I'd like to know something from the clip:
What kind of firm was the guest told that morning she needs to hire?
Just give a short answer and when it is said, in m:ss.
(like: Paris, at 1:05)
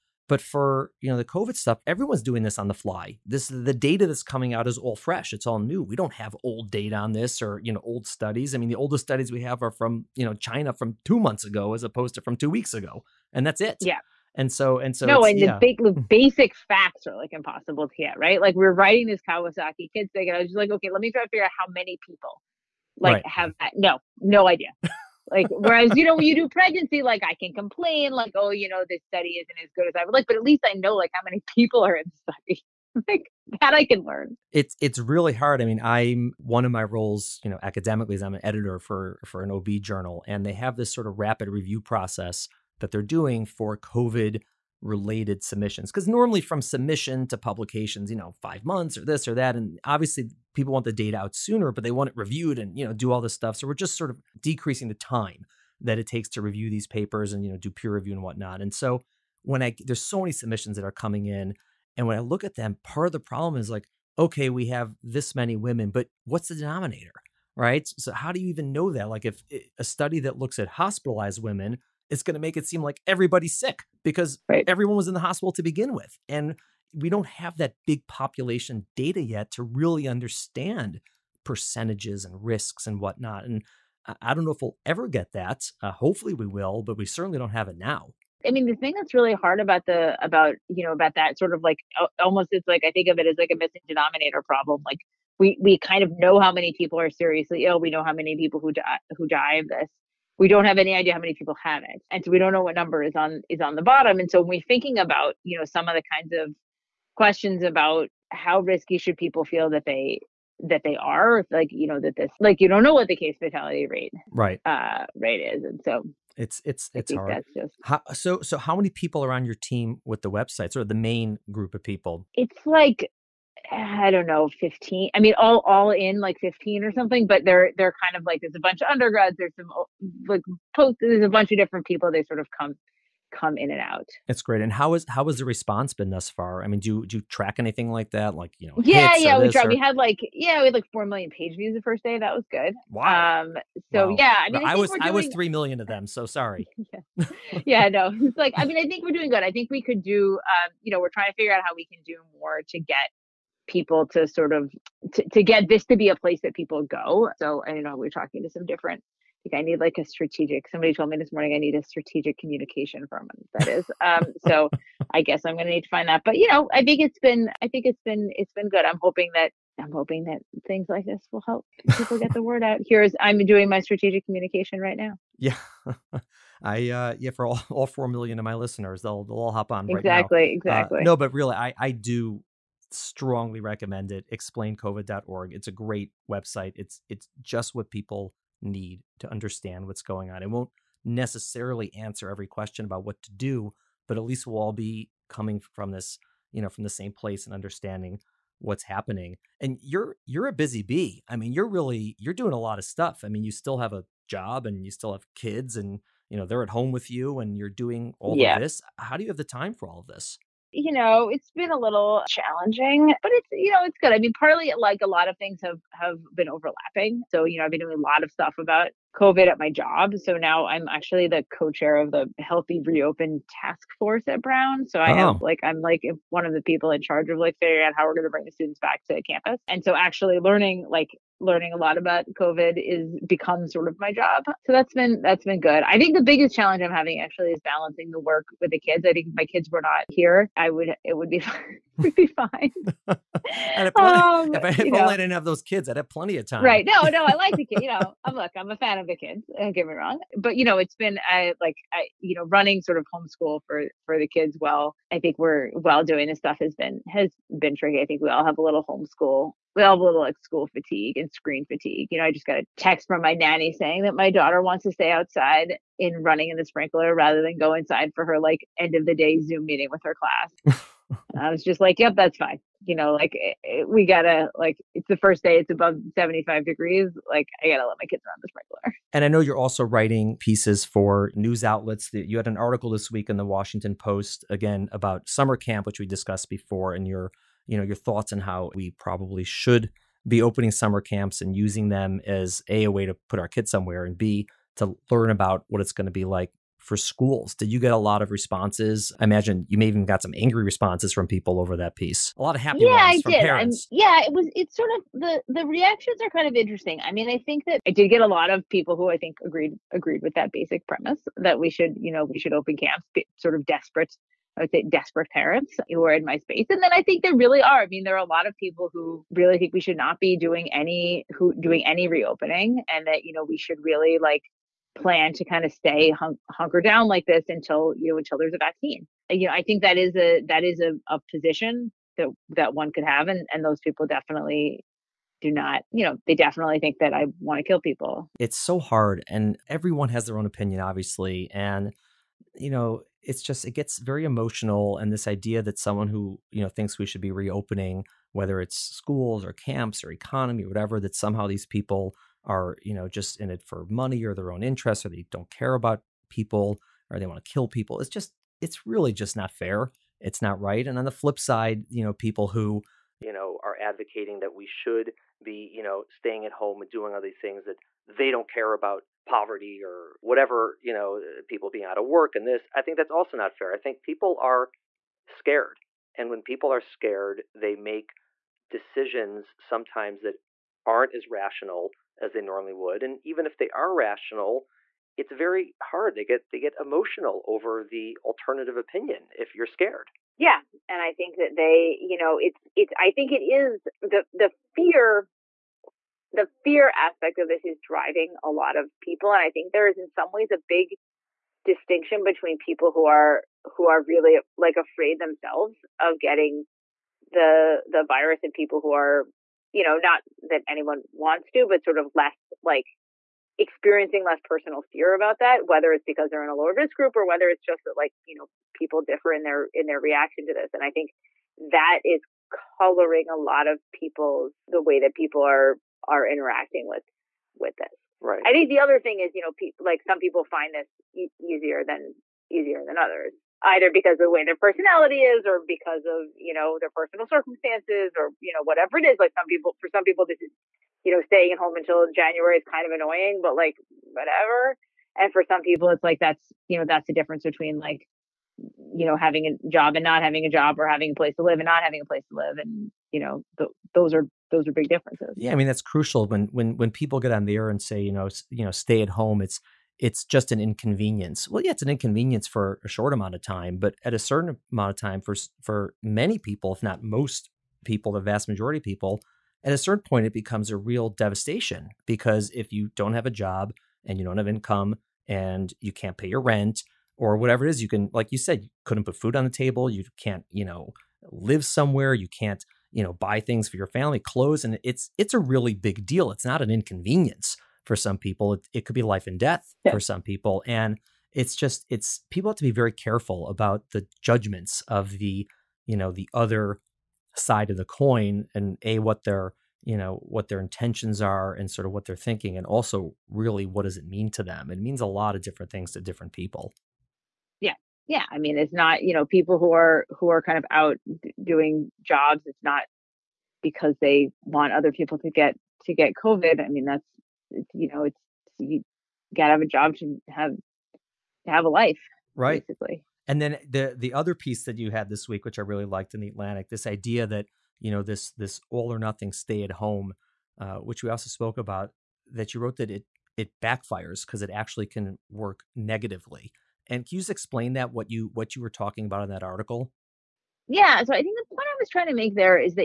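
strategic communication firm, at 2:41.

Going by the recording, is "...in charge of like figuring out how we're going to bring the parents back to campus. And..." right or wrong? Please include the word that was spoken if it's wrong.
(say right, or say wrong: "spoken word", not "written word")
wrong: "students", not "parents".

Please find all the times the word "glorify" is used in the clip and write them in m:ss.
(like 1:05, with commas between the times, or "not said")
not said.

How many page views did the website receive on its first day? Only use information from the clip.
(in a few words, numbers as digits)
4 million.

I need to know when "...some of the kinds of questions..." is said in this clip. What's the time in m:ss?
1:45.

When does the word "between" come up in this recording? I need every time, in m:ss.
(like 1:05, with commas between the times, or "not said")
6:42, 7:27.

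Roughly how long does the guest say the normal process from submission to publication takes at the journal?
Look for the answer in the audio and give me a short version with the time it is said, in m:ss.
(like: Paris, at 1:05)
5 months, at 0:48.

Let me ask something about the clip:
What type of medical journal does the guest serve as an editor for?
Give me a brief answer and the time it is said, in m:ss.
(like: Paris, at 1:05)
OB journal, at 0:39.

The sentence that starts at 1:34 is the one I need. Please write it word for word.
Like we we kind of know how many people are seriously ill.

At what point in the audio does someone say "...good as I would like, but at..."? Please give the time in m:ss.
0:29.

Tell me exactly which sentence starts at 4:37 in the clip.
Like I gotta let my kids run the sprinkler.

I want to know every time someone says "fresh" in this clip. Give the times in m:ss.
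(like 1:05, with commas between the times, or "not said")
0:04.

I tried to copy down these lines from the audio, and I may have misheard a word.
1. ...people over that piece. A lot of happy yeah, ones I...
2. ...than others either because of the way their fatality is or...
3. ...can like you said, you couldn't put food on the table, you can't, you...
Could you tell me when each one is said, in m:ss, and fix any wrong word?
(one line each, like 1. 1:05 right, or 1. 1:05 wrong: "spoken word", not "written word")
1. 5:01 right
2. 7:12 wrong: "personality", not "fatality"
3. 7:57 right.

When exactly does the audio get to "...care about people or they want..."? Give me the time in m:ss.
5:55.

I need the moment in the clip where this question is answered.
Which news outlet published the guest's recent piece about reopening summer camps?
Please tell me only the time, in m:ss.
4:43.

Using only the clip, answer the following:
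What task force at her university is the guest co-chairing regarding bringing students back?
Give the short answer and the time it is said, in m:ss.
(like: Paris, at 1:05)
Healthy Reopen Task Force, at 3:42.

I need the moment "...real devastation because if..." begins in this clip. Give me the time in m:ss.
7:50.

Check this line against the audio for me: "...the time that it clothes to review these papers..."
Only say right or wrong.
wrong.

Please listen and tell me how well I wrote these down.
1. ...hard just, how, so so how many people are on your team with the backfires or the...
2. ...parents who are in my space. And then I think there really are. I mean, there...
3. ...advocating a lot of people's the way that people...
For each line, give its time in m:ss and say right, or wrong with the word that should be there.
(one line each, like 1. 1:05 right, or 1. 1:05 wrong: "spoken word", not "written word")
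1. 1:57 wrong: "websites", not "backfires"
2. 5:15 right
3. 7:02 wrong: "coloring", not "advocating".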